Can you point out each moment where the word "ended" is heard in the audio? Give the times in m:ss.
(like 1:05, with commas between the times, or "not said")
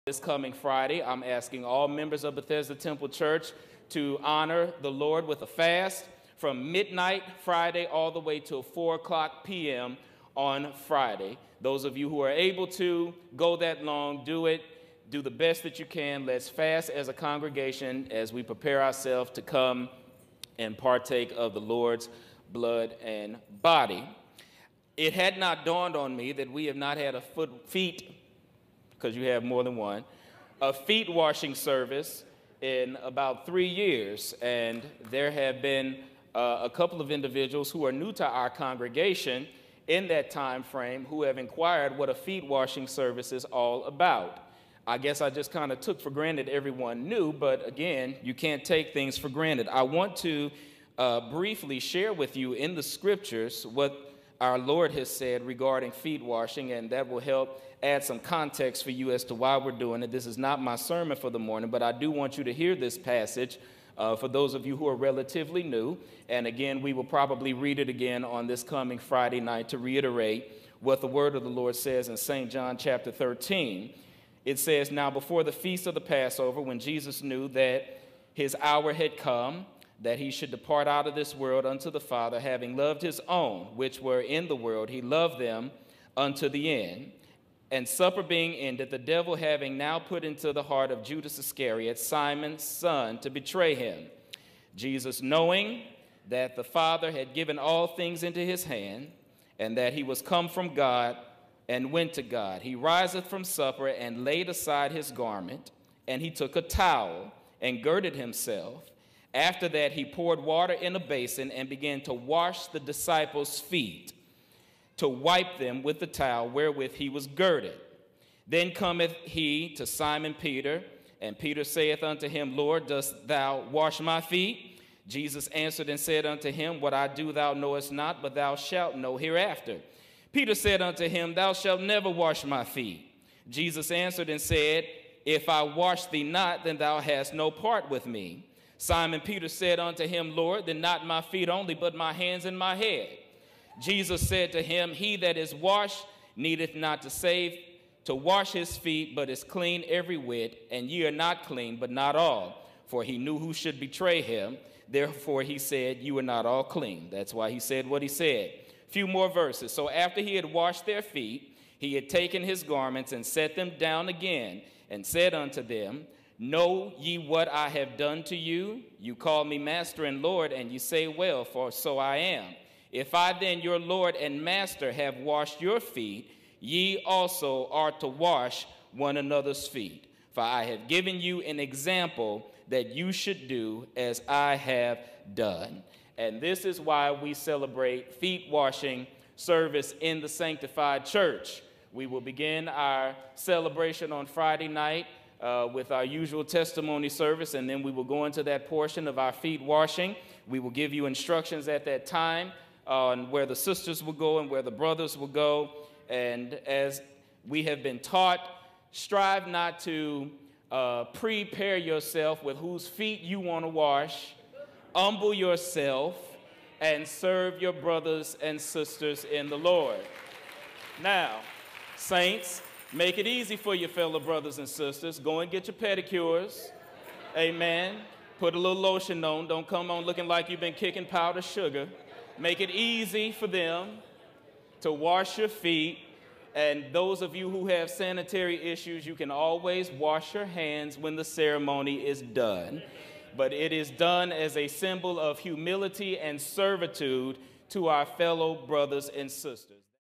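1:28.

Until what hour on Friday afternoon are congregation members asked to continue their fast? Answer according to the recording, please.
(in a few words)
4 p.m.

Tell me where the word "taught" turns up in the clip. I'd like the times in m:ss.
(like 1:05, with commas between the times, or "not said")
3:27.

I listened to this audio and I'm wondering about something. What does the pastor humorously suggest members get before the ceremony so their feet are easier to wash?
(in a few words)
pedicures.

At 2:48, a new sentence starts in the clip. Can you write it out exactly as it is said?
You call me master and Lord, and you say, Well, for so I am.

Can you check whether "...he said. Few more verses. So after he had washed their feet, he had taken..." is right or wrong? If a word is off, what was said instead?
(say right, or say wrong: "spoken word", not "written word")
right.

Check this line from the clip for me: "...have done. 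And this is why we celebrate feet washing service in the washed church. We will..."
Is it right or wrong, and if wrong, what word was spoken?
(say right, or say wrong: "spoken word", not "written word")
wrong: "sanctified", not "washed".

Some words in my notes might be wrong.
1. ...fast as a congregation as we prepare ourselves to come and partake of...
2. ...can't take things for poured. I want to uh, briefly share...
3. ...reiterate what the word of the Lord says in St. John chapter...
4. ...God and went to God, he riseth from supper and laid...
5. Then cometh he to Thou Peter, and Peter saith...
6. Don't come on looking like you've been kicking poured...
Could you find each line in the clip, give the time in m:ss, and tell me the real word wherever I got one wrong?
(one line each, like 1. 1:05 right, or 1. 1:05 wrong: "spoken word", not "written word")
1. 0:16 right
2. 0:48 wrong: "granted", not "poured"
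3. 1:09 right
4. 1:40 right
5. 1:58 wrong: "Simon", not "Thou"
6. 3:49 wrong: "powdered", not "poured".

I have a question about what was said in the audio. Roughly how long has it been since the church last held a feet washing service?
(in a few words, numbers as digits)
3 years.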